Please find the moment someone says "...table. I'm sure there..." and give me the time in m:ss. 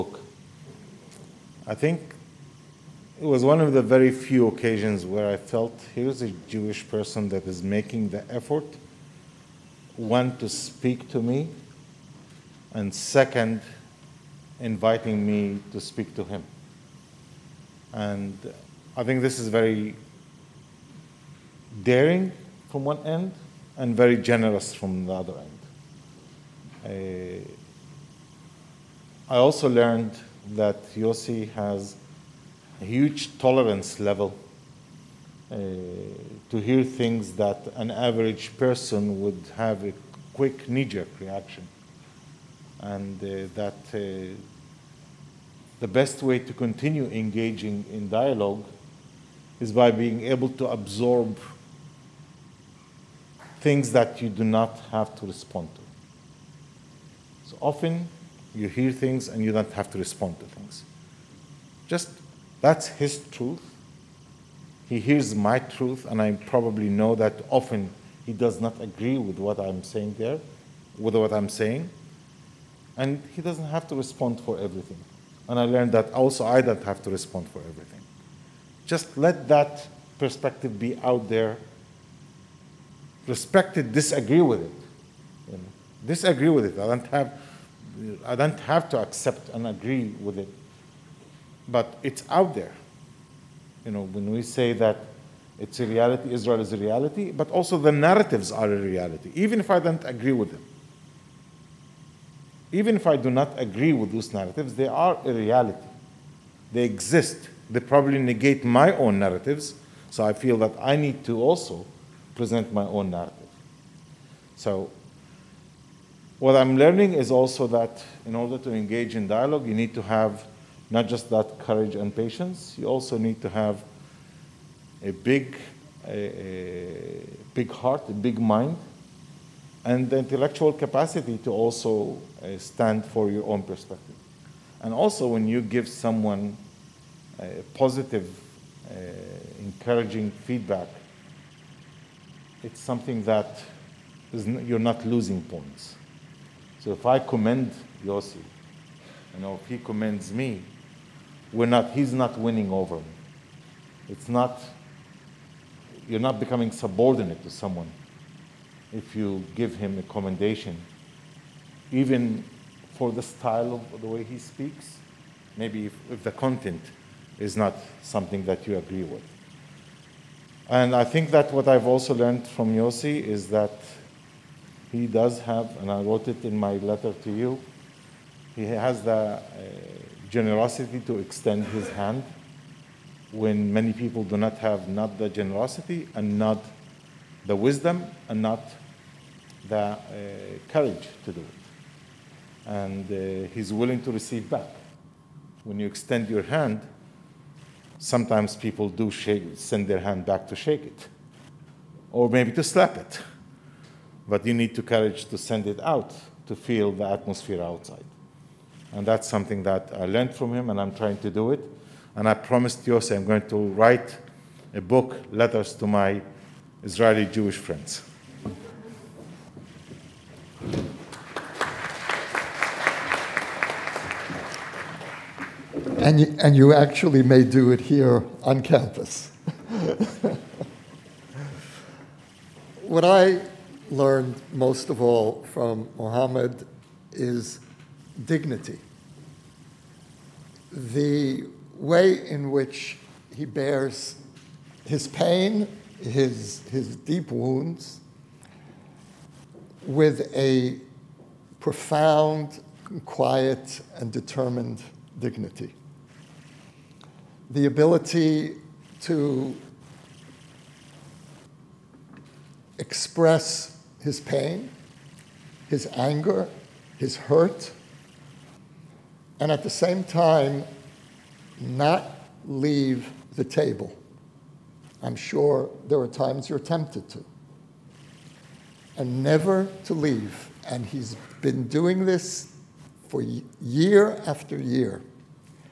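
4:33.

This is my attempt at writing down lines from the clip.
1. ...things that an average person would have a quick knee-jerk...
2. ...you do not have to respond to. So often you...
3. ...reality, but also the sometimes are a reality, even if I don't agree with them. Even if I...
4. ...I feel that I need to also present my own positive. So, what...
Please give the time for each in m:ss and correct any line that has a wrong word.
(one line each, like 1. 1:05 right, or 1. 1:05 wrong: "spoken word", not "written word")
1. 0:36 right
2. 0:54 right
3. 1:36 wrong: "narratives", not "sometimes"
4. 1:50 wrong: "narrative", not "positive".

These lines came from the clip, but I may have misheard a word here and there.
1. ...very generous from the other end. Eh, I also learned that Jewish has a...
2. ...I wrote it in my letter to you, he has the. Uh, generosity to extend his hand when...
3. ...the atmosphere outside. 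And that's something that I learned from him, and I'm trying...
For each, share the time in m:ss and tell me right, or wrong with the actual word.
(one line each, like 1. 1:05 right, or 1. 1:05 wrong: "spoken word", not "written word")
1. 0:23 wrong: "Yossi", not "Jewish"
2. 2:55 right
3. 3:26 right.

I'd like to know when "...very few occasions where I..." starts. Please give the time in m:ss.
0:03.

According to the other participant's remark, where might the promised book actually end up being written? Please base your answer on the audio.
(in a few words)
on campus.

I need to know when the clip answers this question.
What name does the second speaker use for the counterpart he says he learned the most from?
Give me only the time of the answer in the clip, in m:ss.
3:55.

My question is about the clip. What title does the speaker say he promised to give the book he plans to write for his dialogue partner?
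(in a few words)
Letters to My Israeli Jewish Friends.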